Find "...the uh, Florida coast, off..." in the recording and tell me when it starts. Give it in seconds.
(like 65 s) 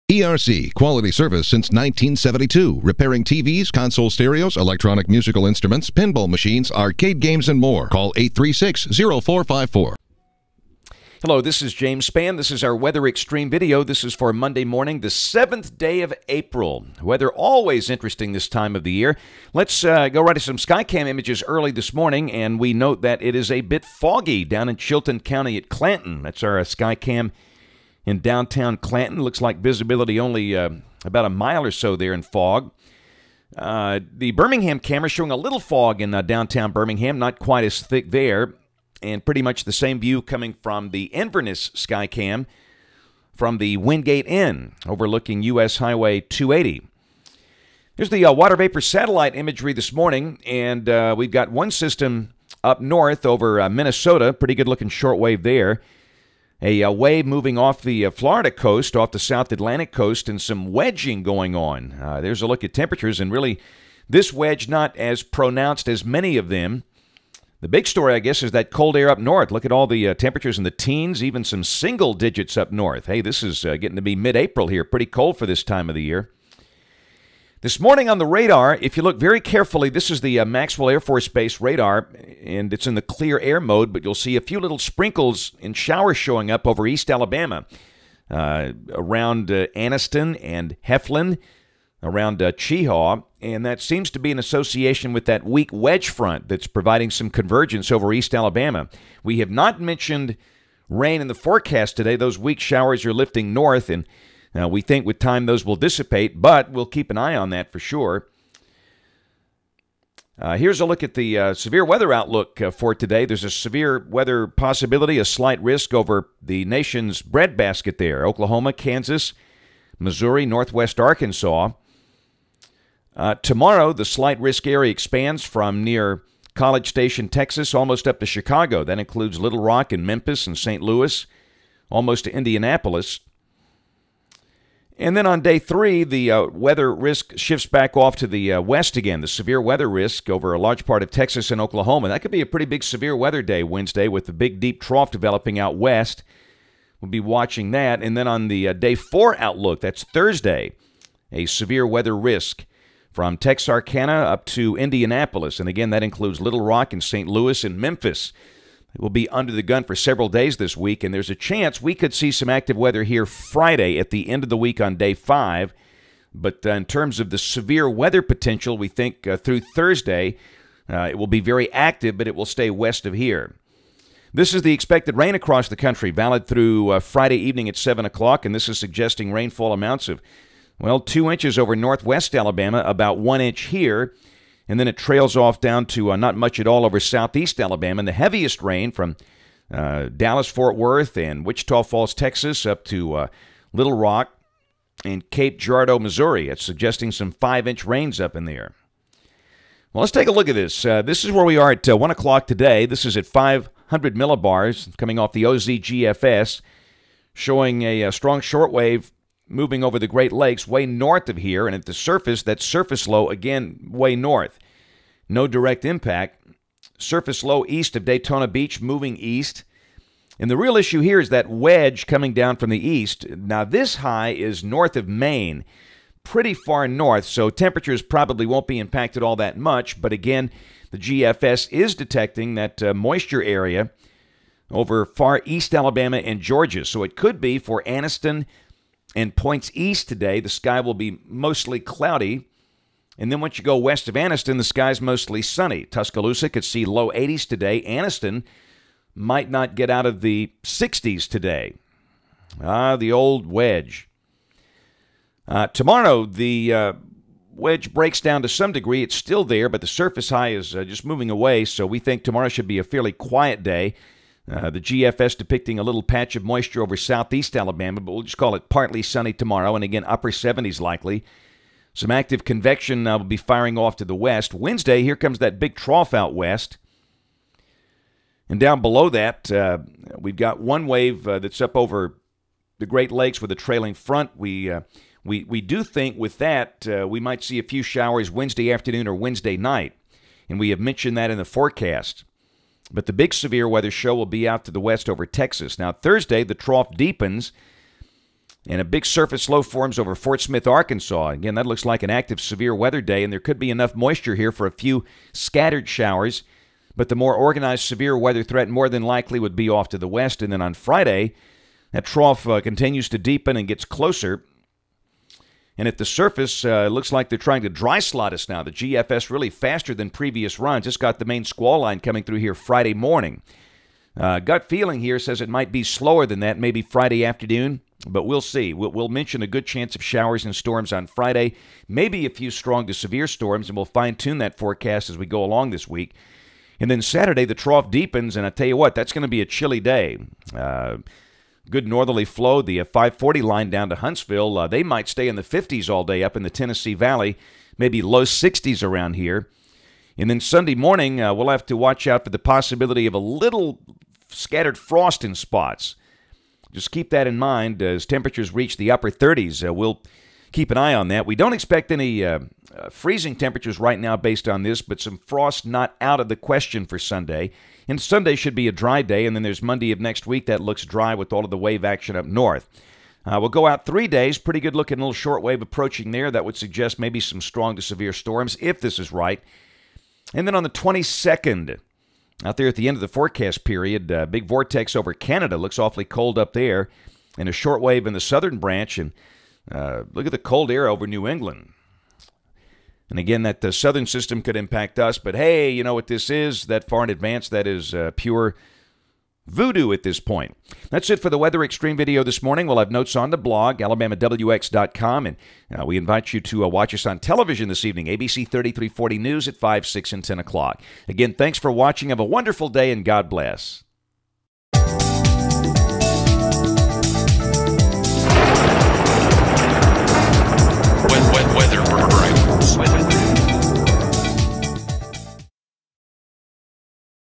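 57 s.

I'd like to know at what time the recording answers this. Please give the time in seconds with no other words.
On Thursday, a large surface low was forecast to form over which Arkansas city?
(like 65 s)
300 s.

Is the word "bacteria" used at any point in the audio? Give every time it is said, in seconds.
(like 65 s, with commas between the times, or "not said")
not said.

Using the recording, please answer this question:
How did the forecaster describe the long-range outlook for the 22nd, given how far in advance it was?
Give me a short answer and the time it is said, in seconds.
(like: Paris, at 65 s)
pure voodoo, at 398 s.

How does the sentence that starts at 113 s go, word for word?
There's a severe weather possibility, a slight risk over the nation's breadbasket there Oklahoma, Kansas, Missouri, Northwest Arkansas.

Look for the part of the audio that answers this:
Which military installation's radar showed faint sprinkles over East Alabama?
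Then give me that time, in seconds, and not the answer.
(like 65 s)
80 s.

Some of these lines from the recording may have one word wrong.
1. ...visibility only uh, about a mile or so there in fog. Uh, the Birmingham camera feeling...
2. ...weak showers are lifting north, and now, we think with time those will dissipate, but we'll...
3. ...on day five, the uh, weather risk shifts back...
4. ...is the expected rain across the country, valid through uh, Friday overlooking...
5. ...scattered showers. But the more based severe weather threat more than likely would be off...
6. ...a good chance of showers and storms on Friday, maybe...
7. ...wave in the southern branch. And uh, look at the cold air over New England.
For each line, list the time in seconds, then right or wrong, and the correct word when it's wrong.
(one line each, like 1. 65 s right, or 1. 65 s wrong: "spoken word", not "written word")
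1. 29 s wrong: "showing", not "feeling"
2. 102 s right
3. 135 s wrong: "three", not "five"
4. 174 s wrong: "evening", not "overlooking"
5. 305 s wrong: "organized", not "based"
6. 329 s right
7. 387 s right.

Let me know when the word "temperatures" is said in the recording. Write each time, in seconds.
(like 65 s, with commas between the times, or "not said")
62 s, 70 s, 227 s, 358 s, 363 s.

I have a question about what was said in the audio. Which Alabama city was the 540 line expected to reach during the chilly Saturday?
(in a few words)
Huntsville.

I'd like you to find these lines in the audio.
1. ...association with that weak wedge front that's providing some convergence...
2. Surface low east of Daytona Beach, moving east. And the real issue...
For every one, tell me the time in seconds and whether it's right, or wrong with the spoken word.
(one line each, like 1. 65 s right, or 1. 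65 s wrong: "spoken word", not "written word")
1. 94 s right
2. 216 s right.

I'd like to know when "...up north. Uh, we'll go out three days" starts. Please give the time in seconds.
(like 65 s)
372 s.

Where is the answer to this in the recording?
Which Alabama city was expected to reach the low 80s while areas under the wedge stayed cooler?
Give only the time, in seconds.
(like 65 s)
245 s.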